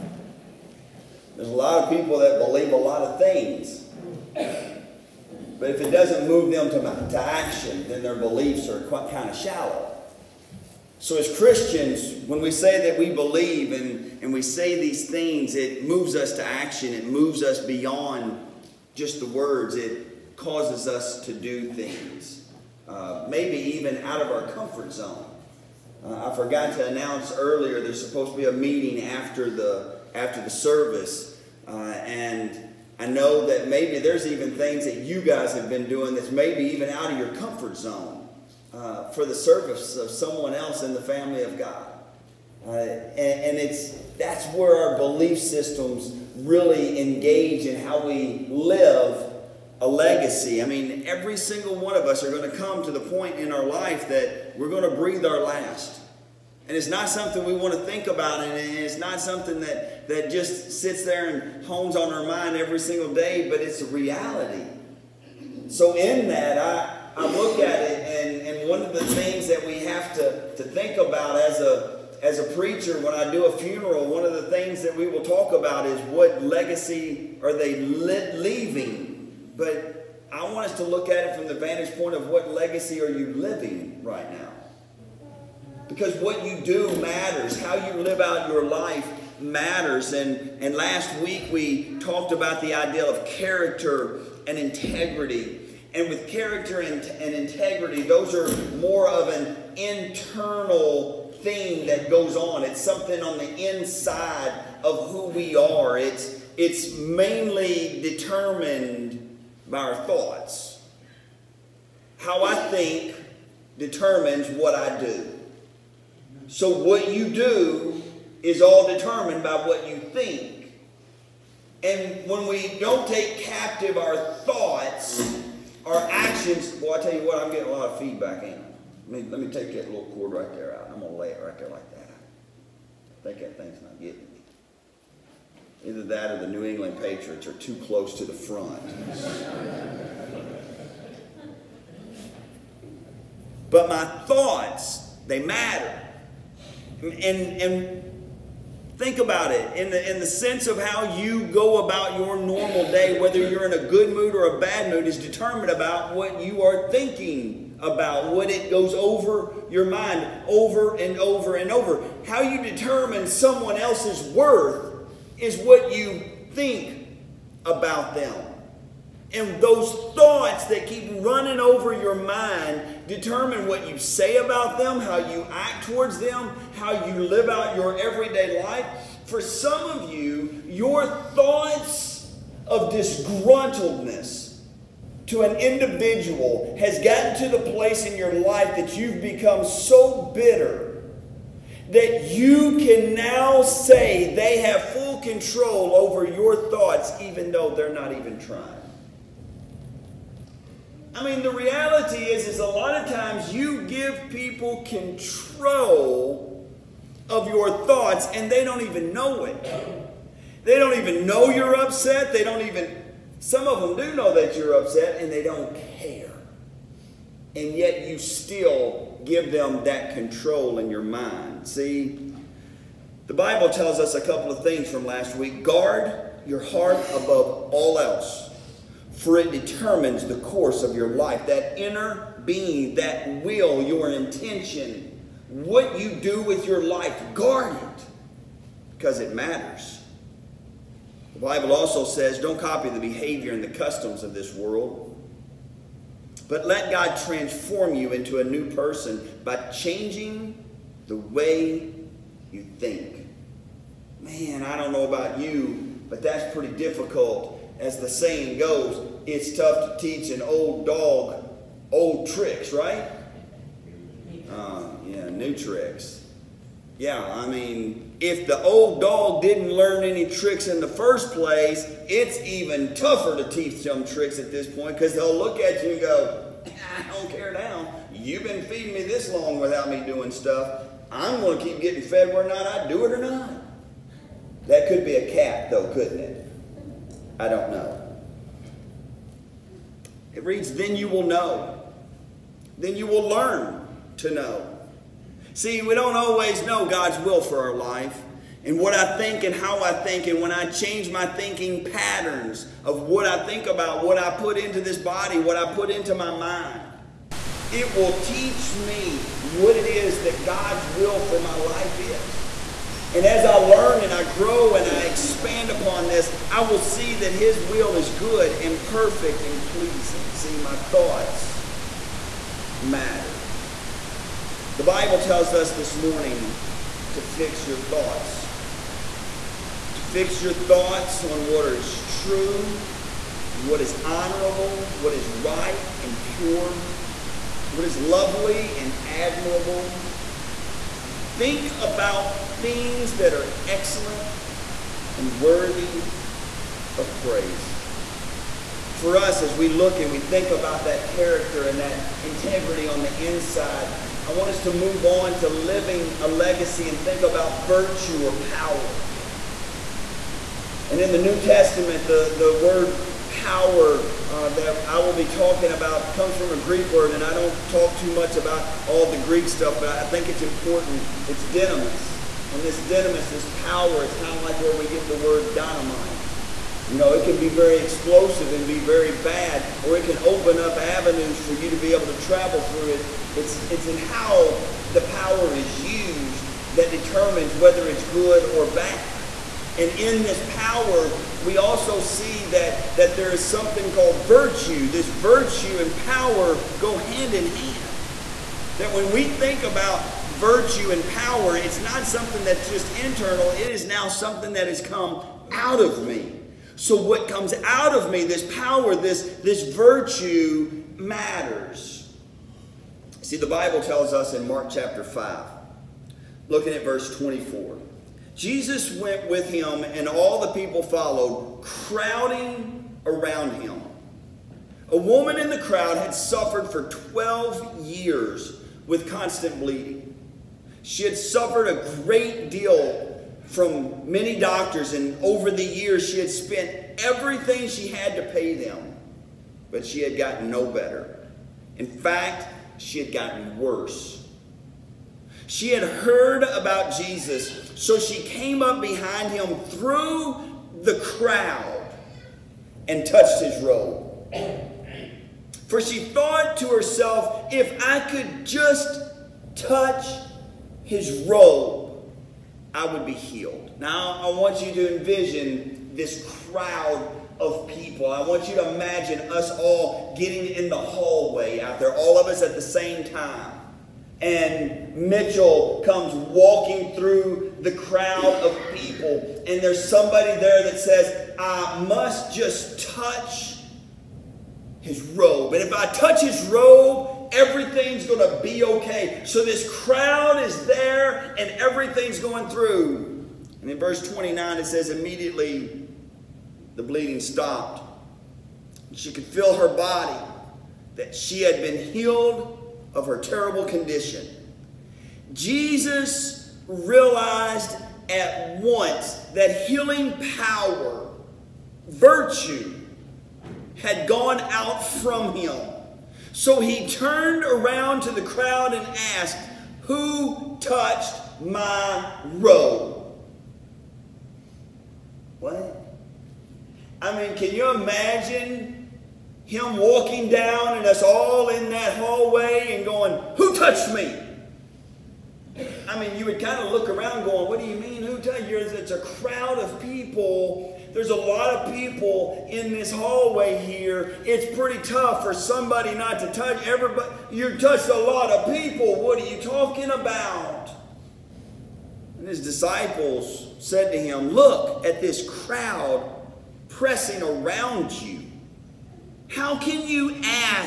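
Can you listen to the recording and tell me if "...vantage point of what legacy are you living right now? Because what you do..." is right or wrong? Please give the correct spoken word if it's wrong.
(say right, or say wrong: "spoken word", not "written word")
right.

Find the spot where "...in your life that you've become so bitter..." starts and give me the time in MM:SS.
03:08.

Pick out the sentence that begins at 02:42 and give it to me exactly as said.
How you determine someone else's worth is what you think about them.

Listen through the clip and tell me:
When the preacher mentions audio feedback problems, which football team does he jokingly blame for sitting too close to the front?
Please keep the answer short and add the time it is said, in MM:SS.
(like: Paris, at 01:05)
New England Patriots, at 02:16.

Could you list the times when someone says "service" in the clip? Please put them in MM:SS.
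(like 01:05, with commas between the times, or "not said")
00:30, 00:39.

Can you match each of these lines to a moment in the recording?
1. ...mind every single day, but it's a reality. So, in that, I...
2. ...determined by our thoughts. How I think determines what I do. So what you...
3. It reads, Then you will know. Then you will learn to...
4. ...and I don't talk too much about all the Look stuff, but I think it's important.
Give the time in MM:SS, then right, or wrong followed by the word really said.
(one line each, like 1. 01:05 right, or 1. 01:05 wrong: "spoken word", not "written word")
1. 01:02 right
2. 01:48 right
3. 04:50 right
4. 06:07 wrong: "Greek", not "Look".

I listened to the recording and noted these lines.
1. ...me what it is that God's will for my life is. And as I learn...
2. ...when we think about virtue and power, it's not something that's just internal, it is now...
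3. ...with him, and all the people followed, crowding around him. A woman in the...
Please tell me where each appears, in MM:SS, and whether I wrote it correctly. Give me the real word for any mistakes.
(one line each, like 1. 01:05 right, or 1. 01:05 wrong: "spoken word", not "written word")
1. 05:08 right
2. 06:38 right
3. 06:59 right.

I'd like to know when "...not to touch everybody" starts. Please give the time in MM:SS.
09:05.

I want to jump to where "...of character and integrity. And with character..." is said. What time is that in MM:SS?
01:33.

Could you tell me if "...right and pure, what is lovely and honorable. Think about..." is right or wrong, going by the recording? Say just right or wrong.
wrong.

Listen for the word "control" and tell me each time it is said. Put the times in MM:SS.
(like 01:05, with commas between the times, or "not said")
03:15, 03:24, 03:40.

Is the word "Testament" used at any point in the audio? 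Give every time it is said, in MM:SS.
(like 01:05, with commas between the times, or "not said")
06:01.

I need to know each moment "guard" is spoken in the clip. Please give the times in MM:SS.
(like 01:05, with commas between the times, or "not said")
03:45, 03:57.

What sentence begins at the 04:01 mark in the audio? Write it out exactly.
The Bible also says don't copy the behavior and the customs of this world.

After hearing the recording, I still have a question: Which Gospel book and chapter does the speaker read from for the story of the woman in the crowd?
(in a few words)
Mark chapter 5.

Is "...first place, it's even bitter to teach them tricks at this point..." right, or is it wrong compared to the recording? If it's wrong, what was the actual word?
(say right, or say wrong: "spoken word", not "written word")
wrong: "tougher", not "bitter".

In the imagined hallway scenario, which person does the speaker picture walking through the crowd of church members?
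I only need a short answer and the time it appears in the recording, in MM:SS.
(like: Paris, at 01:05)
Mitchell, at 07:54.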